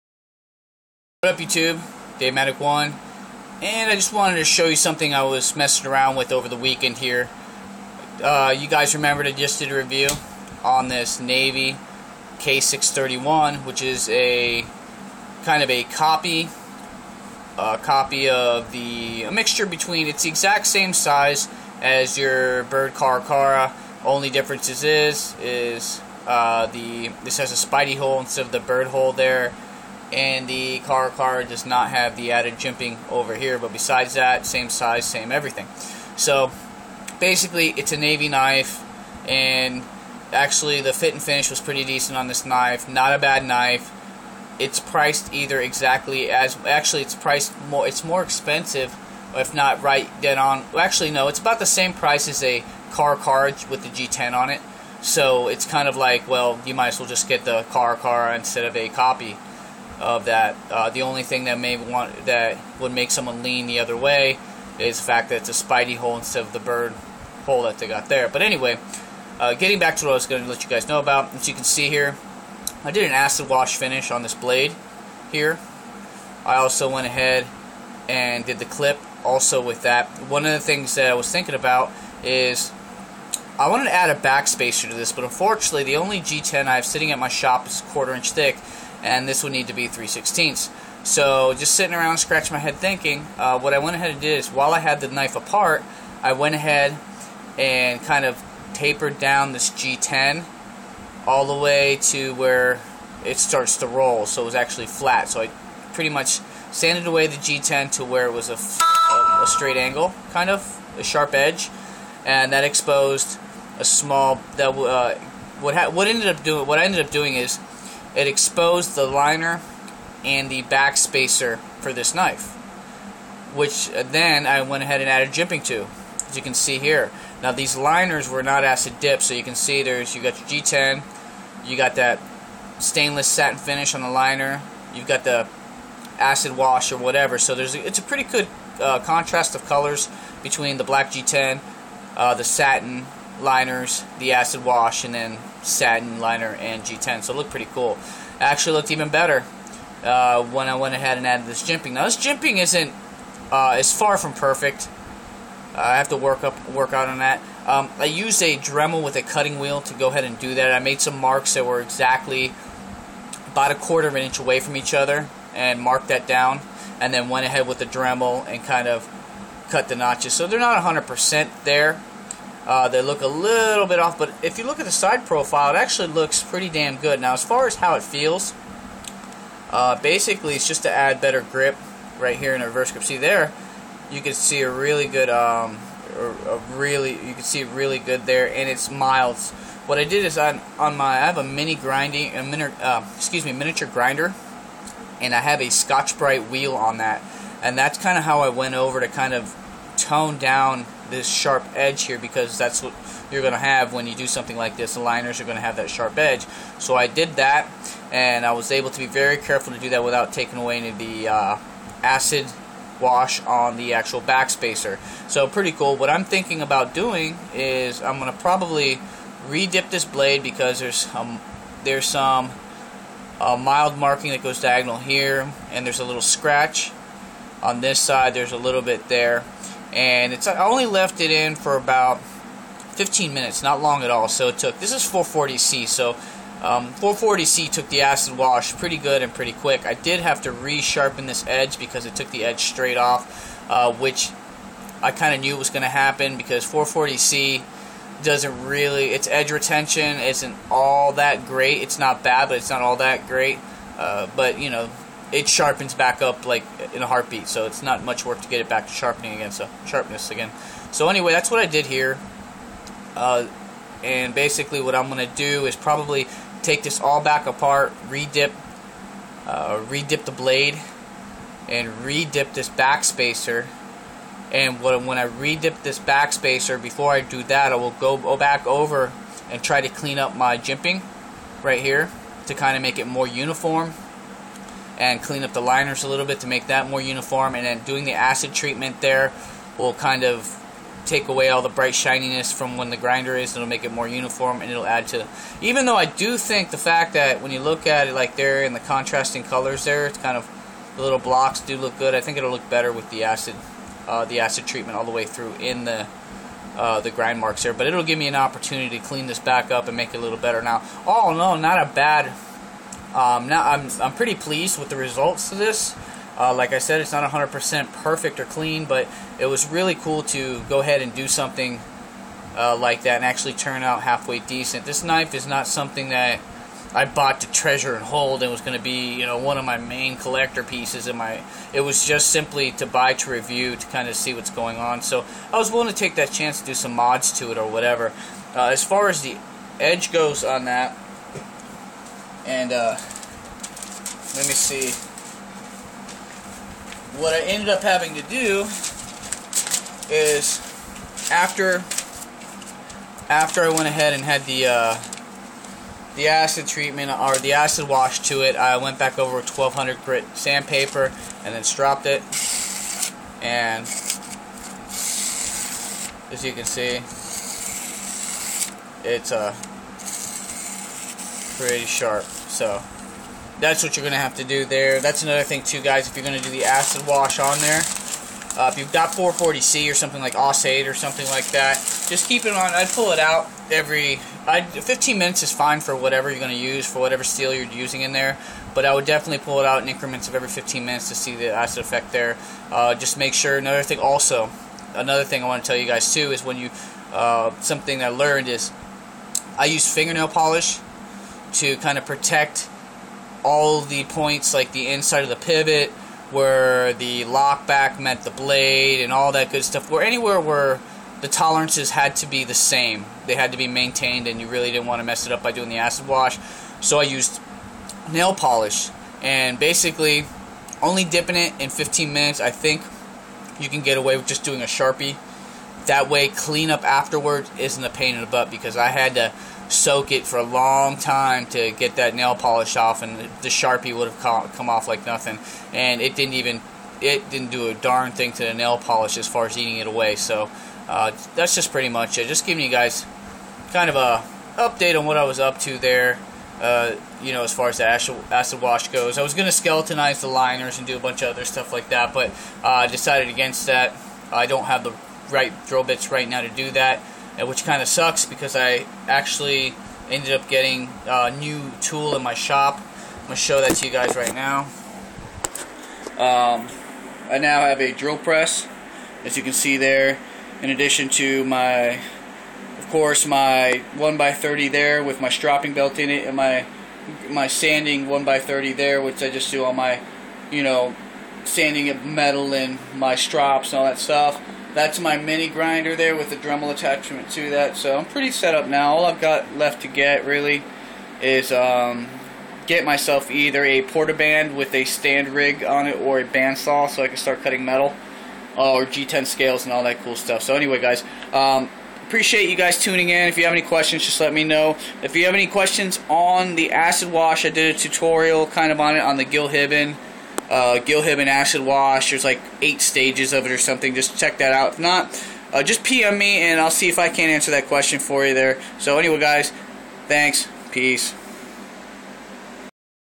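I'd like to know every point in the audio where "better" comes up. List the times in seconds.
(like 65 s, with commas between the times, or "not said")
149 s, 181 s, 302 s, 310 s.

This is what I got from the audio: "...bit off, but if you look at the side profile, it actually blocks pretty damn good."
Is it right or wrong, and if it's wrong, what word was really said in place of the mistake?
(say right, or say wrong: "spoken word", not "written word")
wrong: "looks", not "blocks".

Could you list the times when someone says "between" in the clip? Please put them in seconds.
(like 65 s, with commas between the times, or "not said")
19 s, 140 s.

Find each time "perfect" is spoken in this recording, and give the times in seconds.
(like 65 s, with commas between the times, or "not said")
154 s, 318 s.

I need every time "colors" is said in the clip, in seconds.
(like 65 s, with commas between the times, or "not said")
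139 s, 299 s.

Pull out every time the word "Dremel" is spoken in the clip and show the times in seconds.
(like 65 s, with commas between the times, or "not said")
158 s, 167 s, 486 s.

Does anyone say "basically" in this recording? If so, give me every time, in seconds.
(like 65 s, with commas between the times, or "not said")
37 s, 180 s, 264 s, 419 s.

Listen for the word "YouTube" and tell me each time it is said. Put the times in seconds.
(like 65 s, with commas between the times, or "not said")
1 s.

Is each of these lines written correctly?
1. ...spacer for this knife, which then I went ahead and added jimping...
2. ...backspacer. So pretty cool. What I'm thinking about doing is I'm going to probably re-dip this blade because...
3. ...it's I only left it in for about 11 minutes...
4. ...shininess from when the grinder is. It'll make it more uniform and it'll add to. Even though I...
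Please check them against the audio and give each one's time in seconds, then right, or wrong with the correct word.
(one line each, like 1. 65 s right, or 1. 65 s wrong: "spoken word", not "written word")
1. 120 s right
2. 214 s right
3. 230 s wrong: "15", not "11"
4. 291 s right.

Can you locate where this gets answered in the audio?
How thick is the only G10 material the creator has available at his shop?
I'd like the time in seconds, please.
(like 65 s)
87 s.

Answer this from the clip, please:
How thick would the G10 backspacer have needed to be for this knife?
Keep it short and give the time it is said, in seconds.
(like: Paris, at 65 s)
3/16, at 89 s.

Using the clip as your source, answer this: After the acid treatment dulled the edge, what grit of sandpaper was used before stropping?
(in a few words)
1200.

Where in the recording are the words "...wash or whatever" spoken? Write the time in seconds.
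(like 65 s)
136 s.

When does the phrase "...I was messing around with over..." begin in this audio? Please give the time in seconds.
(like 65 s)
5 s.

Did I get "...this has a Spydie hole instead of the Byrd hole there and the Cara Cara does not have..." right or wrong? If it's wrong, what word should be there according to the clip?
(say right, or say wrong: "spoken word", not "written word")
right.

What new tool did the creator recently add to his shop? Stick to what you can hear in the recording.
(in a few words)
drill press.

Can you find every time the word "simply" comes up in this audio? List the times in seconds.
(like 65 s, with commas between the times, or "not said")
332 s.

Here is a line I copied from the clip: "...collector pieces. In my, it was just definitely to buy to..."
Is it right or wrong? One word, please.
wrong.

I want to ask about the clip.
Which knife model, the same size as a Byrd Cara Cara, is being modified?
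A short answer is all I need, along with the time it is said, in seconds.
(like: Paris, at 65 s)
Navy K631, at 11 s.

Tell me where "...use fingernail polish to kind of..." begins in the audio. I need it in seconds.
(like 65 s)
399 s.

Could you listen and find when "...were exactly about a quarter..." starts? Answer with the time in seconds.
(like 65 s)
161 s.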